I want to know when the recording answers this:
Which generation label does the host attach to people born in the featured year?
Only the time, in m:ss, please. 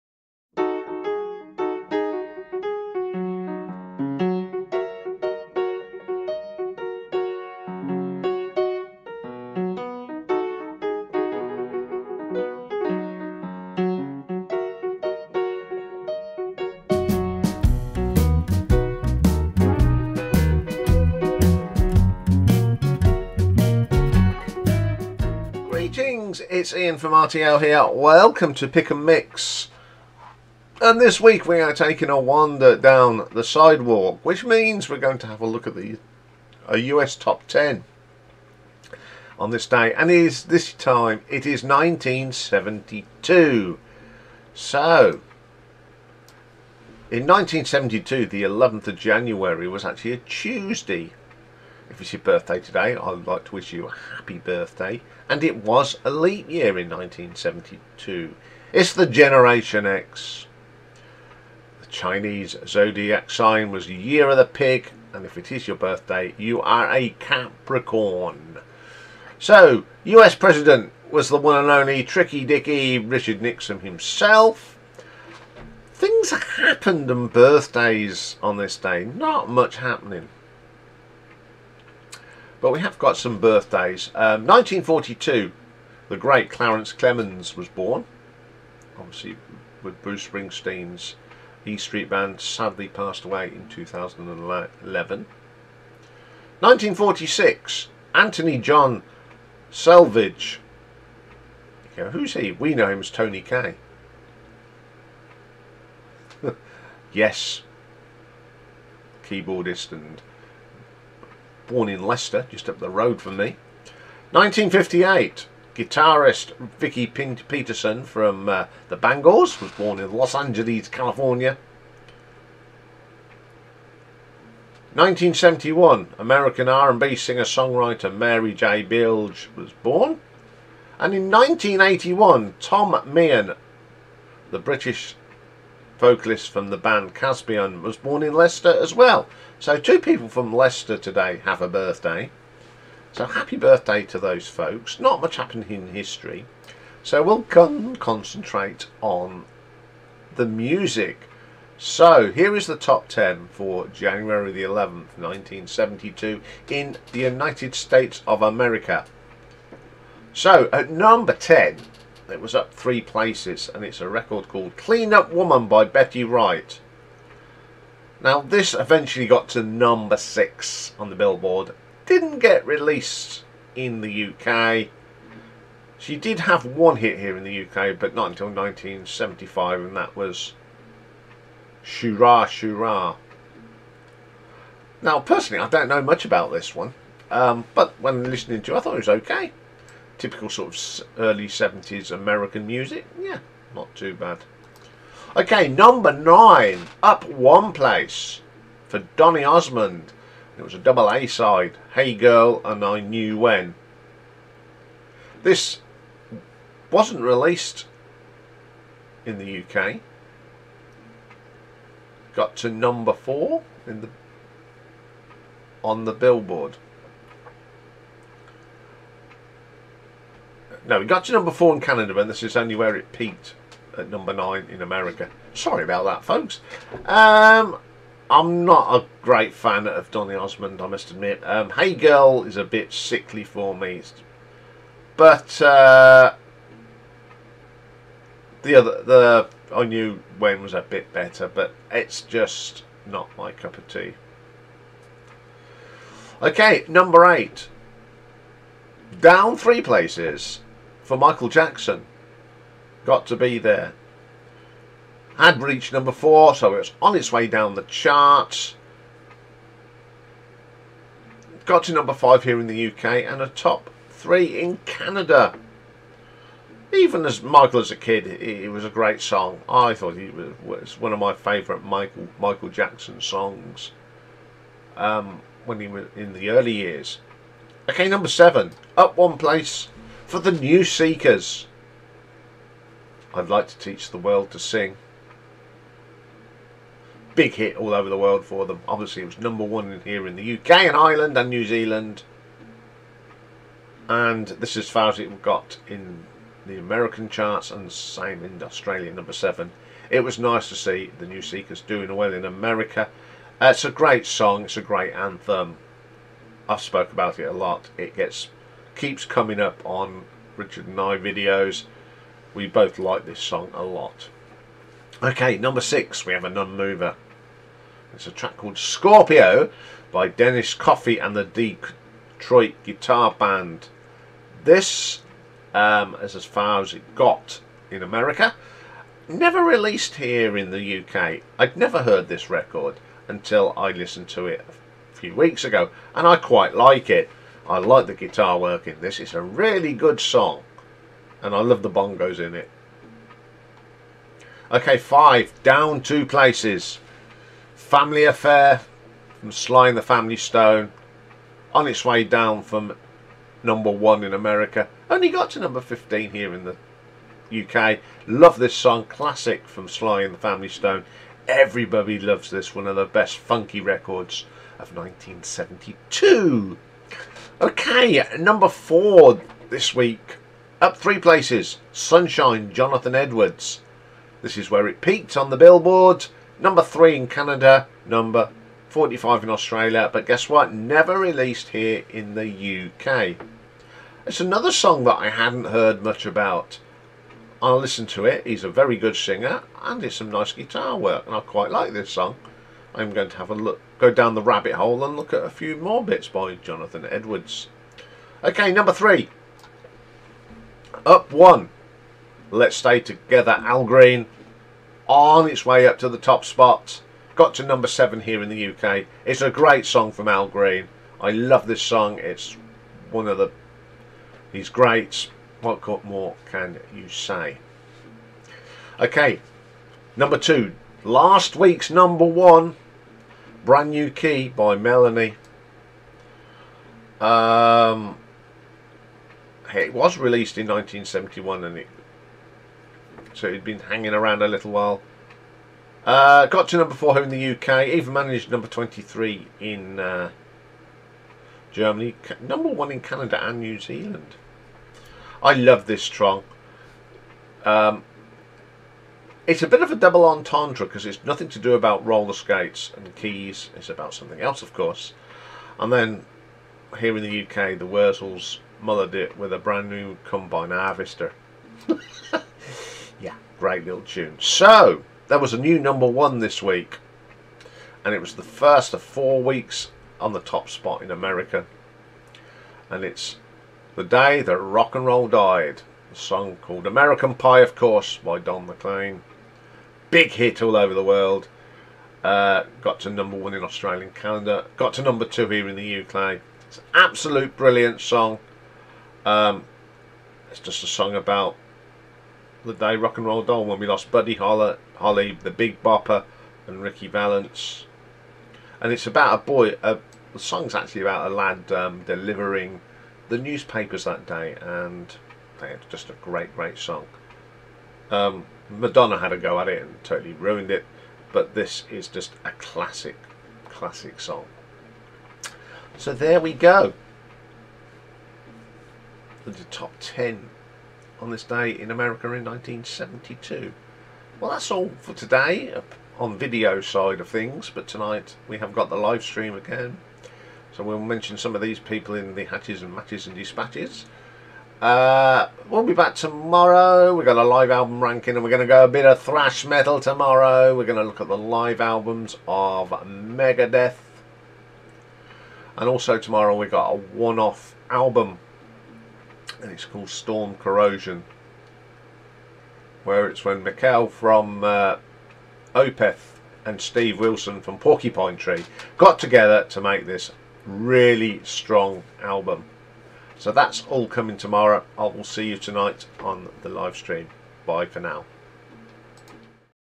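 0:59.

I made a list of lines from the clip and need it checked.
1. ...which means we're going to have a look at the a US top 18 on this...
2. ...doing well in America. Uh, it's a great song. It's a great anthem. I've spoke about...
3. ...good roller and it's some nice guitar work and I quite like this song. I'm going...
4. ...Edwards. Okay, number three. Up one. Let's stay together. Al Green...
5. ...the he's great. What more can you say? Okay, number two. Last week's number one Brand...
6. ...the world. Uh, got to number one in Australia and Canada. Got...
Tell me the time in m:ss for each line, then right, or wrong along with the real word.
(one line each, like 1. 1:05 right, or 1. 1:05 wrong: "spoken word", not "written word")
1. 0:34 wrong: "10", not "18"
2. 5:01 right
3. 6:28 wrong: "singer", not "roller"
4. 6:37 right
5. 6:53 right
6. 8:00 right.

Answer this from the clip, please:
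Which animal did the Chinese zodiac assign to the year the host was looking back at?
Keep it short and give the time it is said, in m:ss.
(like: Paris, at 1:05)
Pig, at 1:03.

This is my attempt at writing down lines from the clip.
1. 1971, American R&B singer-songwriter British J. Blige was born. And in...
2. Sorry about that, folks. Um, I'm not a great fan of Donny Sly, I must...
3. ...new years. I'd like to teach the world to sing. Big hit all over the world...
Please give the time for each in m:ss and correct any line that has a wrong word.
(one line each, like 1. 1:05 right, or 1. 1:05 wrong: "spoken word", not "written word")
1. 2:04 wrong: "Mary", not "British"
2. 3:45 wrong: "Osmond", not "Sly"
3. 4:40 wrong: "seekers", not "years".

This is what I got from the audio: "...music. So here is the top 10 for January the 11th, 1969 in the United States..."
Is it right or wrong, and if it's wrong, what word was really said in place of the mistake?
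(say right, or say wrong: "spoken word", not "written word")
wrong: "1972", not "1969".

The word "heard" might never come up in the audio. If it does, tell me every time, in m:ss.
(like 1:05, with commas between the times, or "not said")
5:32, 6:25.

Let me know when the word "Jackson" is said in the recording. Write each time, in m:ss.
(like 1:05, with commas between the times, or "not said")
4:11, 4:32.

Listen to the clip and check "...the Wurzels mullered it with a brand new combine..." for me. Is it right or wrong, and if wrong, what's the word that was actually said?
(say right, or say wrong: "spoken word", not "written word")
right.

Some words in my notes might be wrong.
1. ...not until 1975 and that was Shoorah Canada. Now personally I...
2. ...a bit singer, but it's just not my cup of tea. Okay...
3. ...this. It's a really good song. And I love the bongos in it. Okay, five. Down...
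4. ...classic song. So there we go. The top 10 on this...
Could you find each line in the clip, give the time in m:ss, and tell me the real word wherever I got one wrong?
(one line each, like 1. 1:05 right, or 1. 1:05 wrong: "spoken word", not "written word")
1. 2:58 wrong: "Shoorah", not "Canada"
2. 4:00 wrong: "better", not "singer"
3. 5:39 right
4. 8:33 right.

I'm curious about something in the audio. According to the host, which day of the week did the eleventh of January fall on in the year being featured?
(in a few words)
Tuesday.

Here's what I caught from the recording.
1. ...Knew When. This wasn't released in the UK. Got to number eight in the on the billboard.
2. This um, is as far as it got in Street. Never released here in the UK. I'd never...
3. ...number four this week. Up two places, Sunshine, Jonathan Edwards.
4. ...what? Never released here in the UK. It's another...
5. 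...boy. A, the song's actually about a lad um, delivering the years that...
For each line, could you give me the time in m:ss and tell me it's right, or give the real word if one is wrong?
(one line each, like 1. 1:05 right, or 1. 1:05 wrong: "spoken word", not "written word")
1. 3:22 wrong: "four", not "eight"
2. 5:24 wrong: "America", not "Street"
3. 6:08 wrong: "three", not "two"
4. 6:20 right
5. 8:19 wrong: "newspapers", not "years".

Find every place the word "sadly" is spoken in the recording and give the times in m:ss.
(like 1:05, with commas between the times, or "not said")
1:32.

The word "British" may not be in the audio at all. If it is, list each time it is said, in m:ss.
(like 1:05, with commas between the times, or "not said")
2:14.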